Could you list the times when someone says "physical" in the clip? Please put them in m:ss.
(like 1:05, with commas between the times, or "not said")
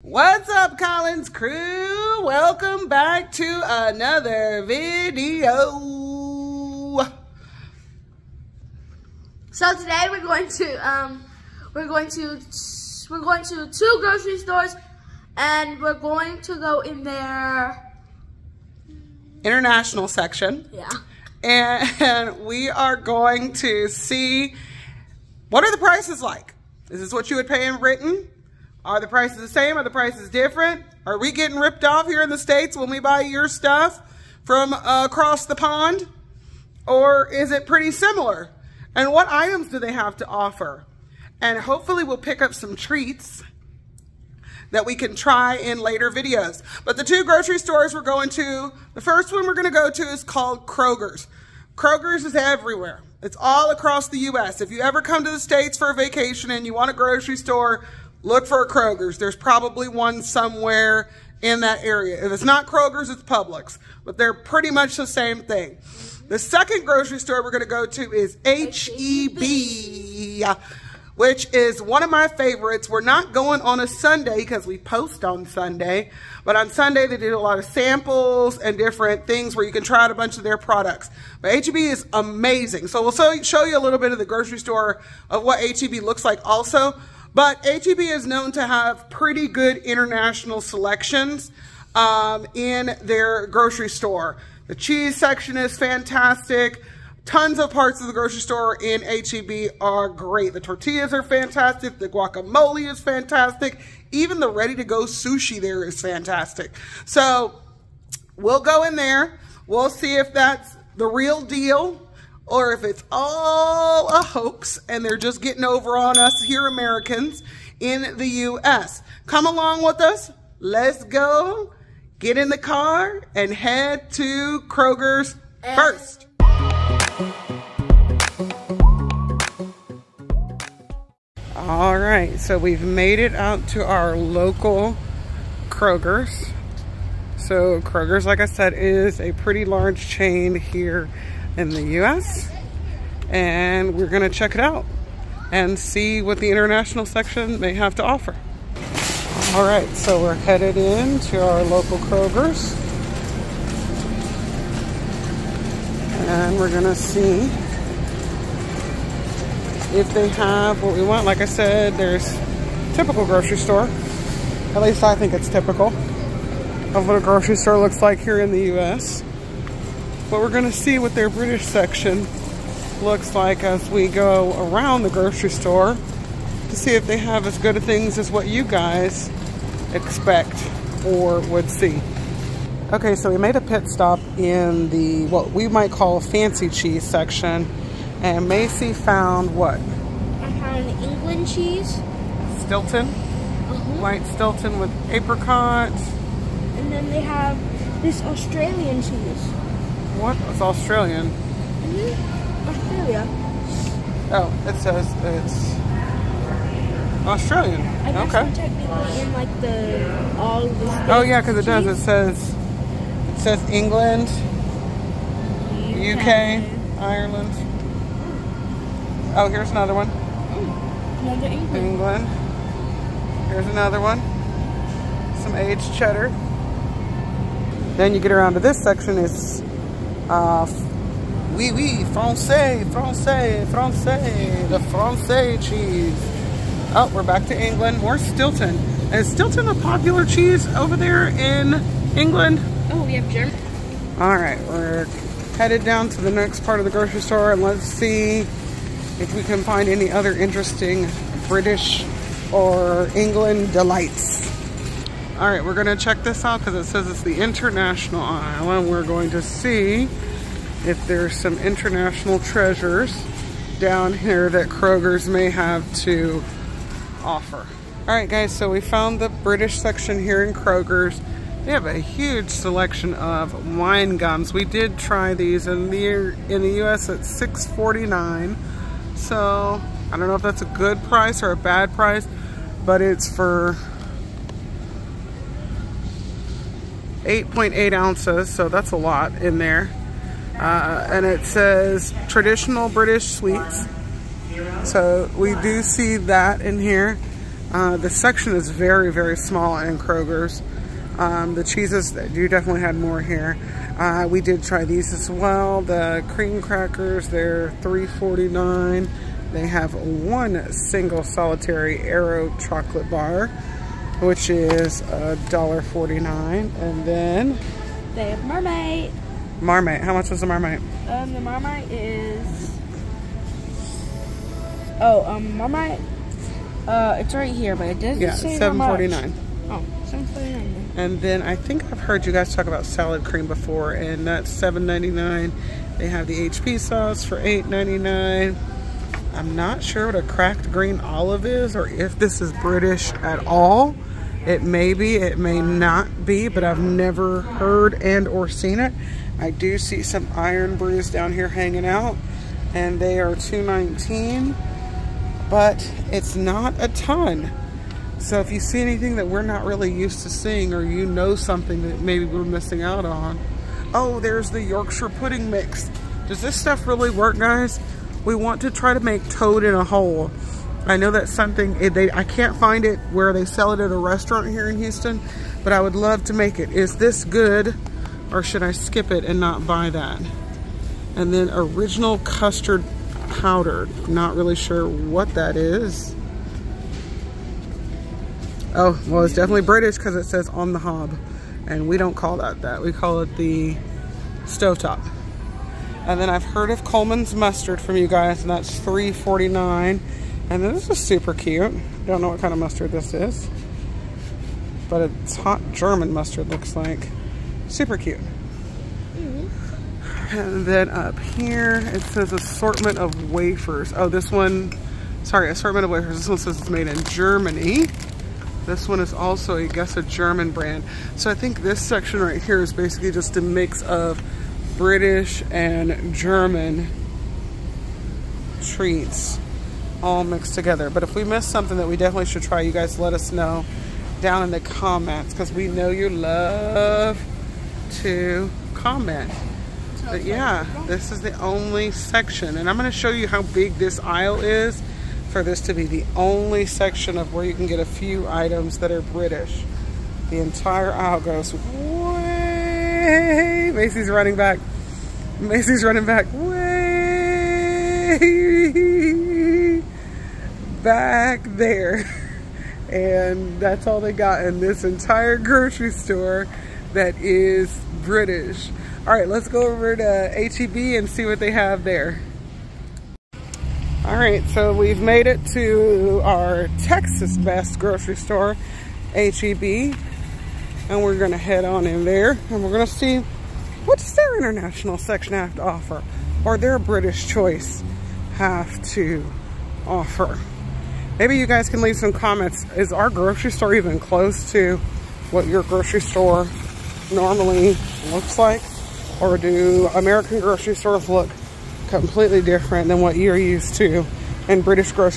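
not said.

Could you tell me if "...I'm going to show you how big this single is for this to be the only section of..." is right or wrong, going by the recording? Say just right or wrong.
wrong.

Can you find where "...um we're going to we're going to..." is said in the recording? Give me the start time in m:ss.
0:10.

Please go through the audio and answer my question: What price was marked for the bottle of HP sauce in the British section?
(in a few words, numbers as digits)
$8.99.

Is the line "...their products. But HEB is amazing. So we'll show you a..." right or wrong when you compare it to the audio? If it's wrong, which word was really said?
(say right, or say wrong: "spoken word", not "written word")
right.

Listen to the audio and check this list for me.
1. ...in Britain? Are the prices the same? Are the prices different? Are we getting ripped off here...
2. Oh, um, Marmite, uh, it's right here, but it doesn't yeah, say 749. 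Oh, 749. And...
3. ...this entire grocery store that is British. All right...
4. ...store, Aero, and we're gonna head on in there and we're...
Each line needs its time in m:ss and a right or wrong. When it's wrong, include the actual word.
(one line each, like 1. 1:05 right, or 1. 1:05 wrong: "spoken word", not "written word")
1. 0:27 right
2. 5:24 right
3. 7:44 right
4. 7:58 wrong: "HEB", not "Aero".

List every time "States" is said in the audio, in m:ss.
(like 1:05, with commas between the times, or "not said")
0:32, 0:55.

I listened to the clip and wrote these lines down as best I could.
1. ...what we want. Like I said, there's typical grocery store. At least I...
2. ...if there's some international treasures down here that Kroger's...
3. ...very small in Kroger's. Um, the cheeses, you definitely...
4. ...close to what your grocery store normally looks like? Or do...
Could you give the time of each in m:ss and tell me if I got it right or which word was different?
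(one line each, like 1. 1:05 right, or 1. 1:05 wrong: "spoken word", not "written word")
1. 2:40 right
2. 4:20 right
3. 4:59 right
4. 8:13 right.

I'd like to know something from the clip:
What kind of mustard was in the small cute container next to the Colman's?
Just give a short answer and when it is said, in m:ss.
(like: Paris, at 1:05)
Hot German mustard, at 6:45.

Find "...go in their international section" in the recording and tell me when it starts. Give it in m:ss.
0:16.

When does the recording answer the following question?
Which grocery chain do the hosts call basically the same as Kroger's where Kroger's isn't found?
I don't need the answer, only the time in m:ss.
1:03.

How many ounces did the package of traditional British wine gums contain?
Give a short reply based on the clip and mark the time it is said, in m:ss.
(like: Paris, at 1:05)
8.8 ounces, at 4:47.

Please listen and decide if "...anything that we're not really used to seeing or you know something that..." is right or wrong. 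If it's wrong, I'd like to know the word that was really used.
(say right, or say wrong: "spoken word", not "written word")
right.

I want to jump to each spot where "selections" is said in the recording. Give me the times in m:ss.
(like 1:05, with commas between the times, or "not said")
1:30, 4:32.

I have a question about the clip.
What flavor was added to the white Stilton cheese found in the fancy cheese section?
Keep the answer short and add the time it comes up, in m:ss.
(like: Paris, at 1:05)
Apricot, at 3:15.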